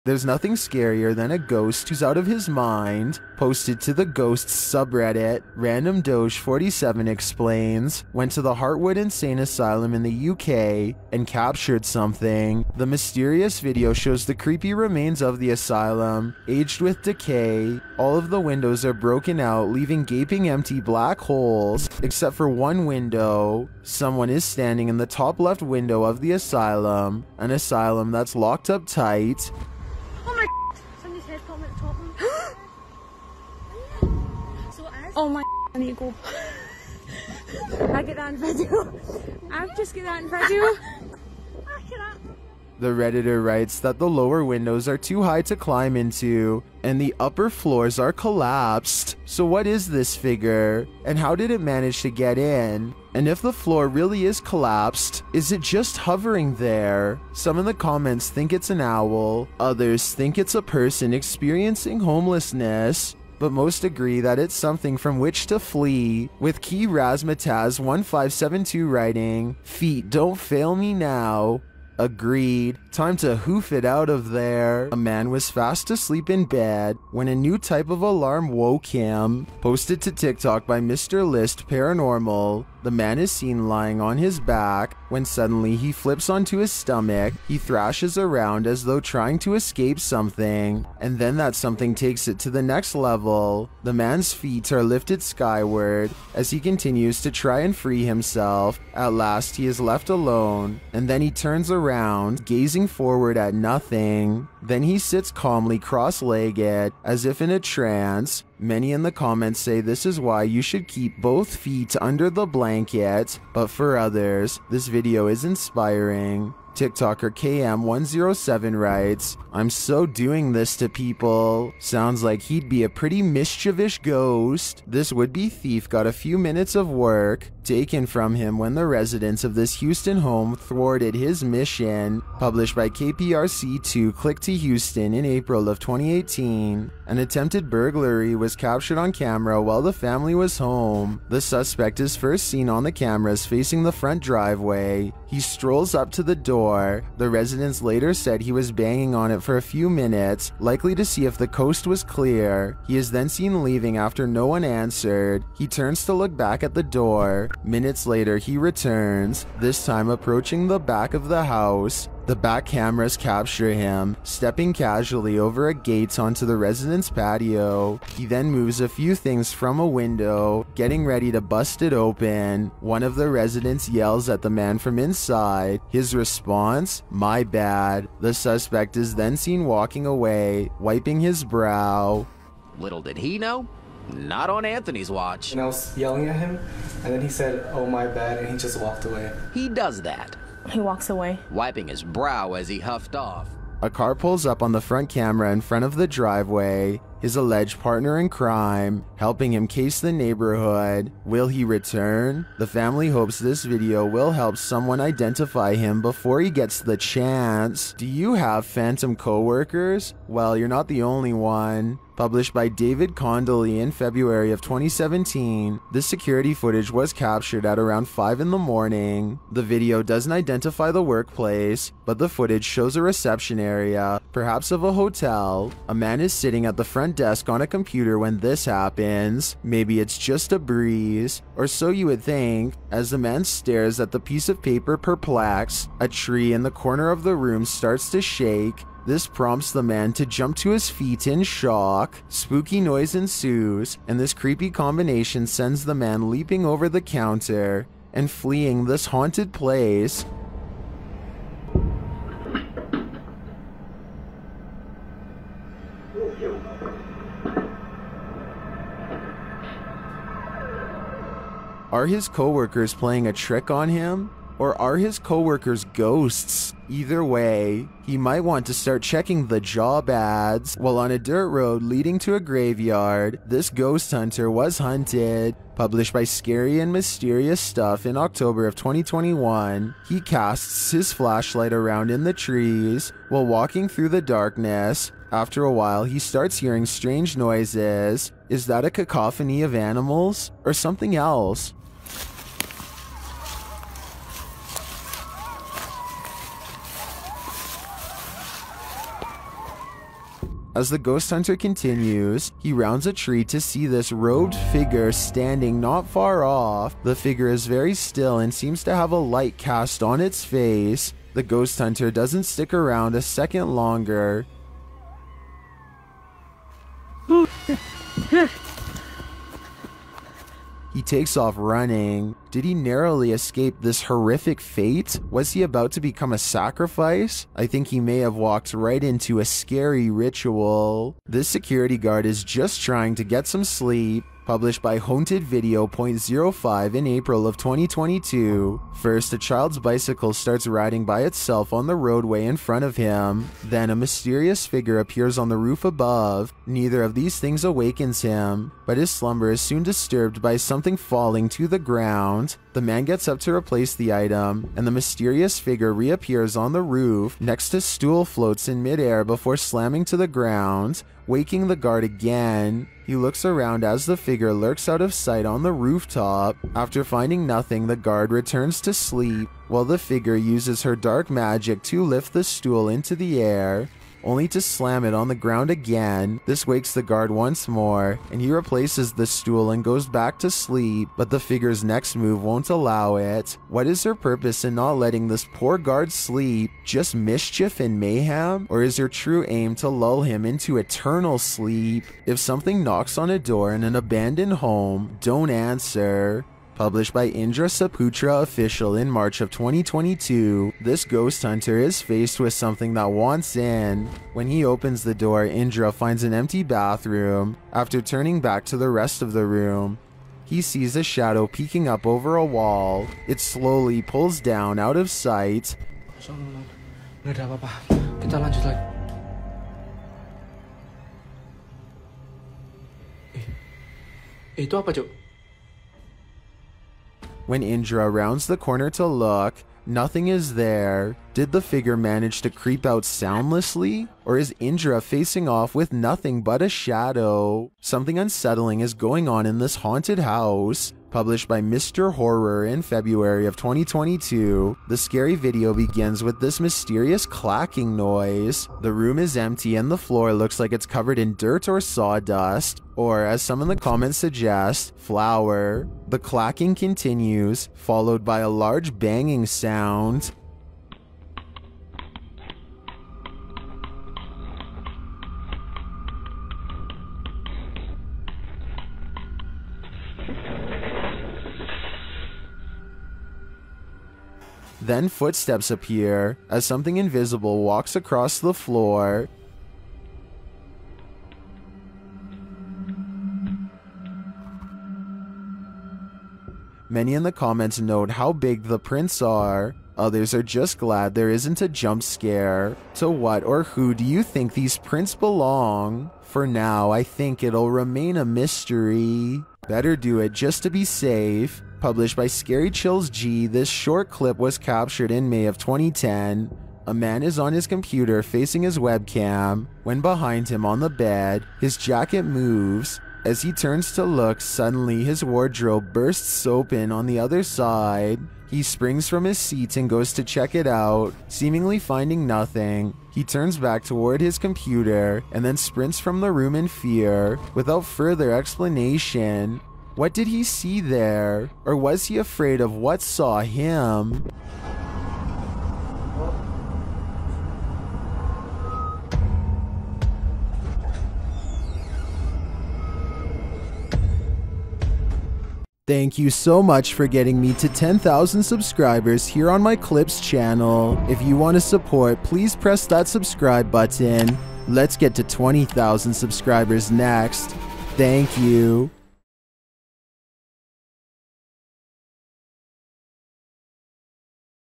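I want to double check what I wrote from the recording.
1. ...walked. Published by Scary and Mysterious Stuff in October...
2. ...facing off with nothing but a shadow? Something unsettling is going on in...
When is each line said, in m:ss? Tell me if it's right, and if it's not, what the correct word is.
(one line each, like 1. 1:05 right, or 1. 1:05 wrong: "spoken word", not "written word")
1. 4:34 wrong: "hunted", not "walked"
2. 7:15 right.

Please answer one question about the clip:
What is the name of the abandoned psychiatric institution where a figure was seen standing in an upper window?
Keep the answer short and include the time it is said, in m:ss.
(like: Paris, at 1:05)
Hartwood Insane Asylum, at 0:08.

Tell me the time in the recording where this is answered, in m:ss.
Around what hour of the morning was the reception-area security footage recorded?
3:38.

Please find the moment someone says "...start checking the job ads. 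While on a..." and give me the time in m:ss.
4:28.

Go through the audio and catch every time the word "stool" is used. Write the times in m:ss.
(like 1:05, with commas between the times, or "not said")
5:57, 6:12, 6:19.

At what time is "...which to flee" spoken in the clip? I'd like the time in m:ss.
1:05.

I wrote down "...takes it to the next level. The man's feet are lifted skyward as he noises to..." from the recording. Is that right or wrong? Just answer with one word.
wrong.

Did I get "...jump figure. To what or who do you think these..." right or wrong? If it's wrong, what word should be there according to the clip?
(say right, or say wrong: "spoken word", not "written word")
wrong: "scare", not "figure".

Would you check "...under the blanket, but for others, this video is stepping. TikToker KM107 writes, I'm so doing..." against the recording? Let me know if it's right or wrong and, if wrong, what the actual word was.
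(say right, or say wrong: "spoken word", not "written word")
wrong: "inspiring", not "stepping".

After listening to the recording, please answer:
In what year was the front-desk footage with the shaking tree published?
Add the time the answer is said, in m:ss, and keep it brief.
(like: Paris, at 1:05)
2017, at 3:34.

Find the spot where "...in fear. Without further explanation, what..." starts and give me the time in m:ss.
8:46.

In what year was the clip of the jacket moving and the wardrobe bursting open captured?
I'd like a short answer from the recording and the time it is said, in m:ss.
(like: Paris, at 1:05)
2010, at 8:25.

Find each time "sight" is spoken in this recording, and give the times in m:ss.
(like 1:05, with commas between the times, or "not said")
6:05, 6:55.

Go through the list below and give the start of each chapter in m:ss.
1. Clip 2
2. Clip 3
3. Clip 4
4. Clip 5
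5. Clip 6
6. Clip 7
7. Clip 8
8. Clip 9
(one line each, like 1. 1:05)
1. 1:14
2. 2:04
3. 3:28
4. 4:30
5. 5:30
6. 6:31
7. 7:19
8. 8:19.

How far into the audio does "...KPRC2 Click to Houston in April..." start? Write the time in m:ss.
2:12.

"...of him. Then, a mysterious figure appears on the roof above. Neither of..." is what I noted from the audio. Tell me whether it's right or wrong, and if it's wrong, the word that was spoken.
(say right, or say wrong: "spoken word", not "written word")
right.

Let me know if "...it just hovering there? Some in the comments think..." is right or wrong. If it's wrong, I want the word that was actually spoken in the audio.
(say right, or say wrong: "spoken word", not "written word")
right.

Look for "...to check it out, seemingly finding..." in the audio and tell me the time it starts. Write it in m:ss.
8:40.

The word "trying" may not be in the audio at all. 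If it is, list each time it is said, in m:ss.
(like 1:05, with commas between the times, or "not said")
1:28, 5:32.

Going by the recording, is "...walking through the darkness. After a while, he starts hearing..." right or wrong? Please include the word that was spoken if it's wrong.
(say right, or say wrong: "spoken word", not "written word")
right.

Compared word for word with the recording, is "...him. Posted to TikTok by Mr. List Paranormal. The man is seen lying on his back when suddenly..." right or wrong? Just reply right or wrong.
right.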